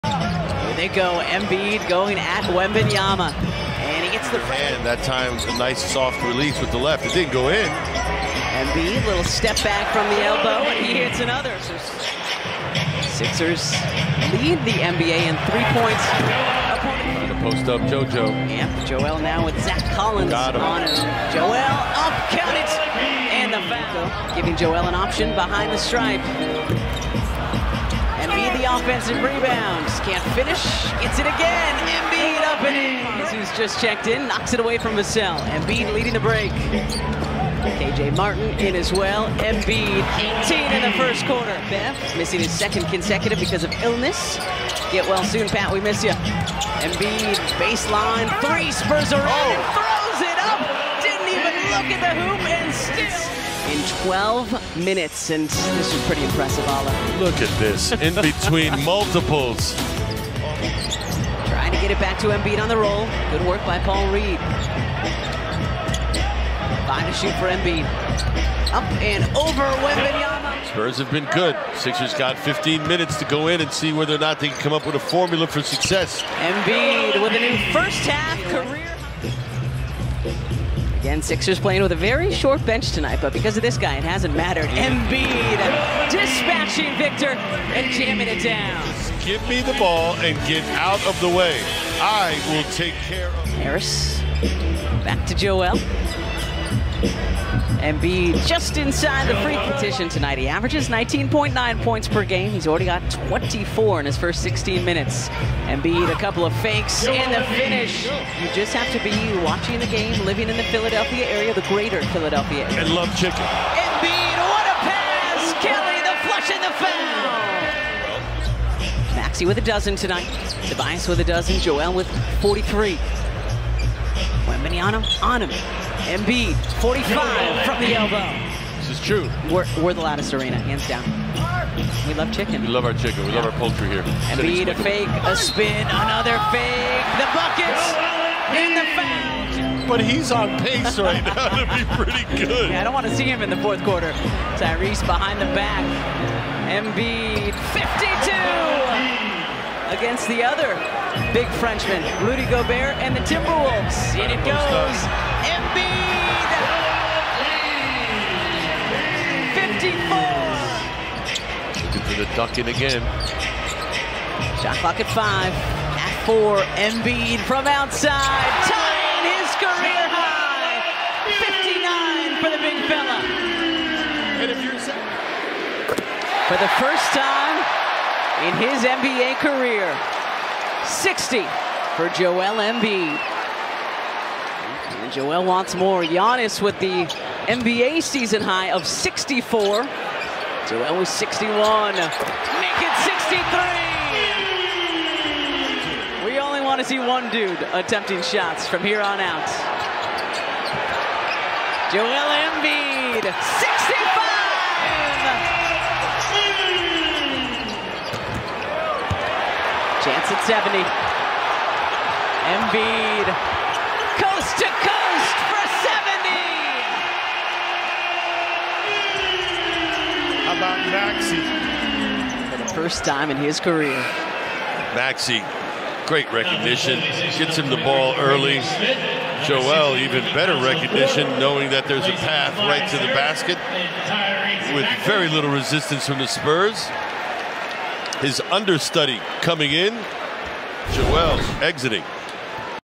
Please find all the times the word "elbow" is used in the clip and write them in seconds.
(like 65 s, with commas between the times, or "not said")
10 s, 127 s.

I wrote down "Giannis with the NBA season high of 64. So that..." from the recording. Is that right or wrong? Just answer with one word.
right.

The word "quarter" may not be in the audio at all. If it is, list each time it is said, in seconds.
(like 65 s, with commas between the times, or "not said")
41 s, 143 s.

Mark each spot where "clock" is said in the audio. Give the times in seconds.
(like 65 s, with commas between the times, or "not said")
164 s.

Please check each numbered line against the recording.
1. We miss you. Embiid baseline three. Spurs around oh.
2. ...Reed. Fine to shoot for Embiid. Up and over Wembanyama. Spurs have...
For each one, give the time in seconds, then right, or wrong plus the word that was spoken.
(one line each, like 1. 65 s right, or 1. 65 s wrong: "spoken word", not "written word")
1. 45 s right
2. 64 s right.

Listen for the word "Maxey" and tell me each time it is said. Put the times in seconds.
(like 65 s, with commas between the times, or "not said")
119 s, 220 s, 224 s.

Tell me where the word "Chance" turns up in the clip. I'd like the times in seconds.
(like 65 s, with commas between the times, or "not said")
210 s.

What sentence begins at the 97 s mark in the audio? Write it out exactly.
Embiid just inside the free petition tonight.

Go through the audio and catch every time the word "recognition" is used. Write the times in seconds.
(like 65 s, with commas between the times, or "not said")
226 s, 230 s.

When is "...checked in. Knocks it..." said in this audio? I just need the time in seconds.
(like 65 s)
33 s.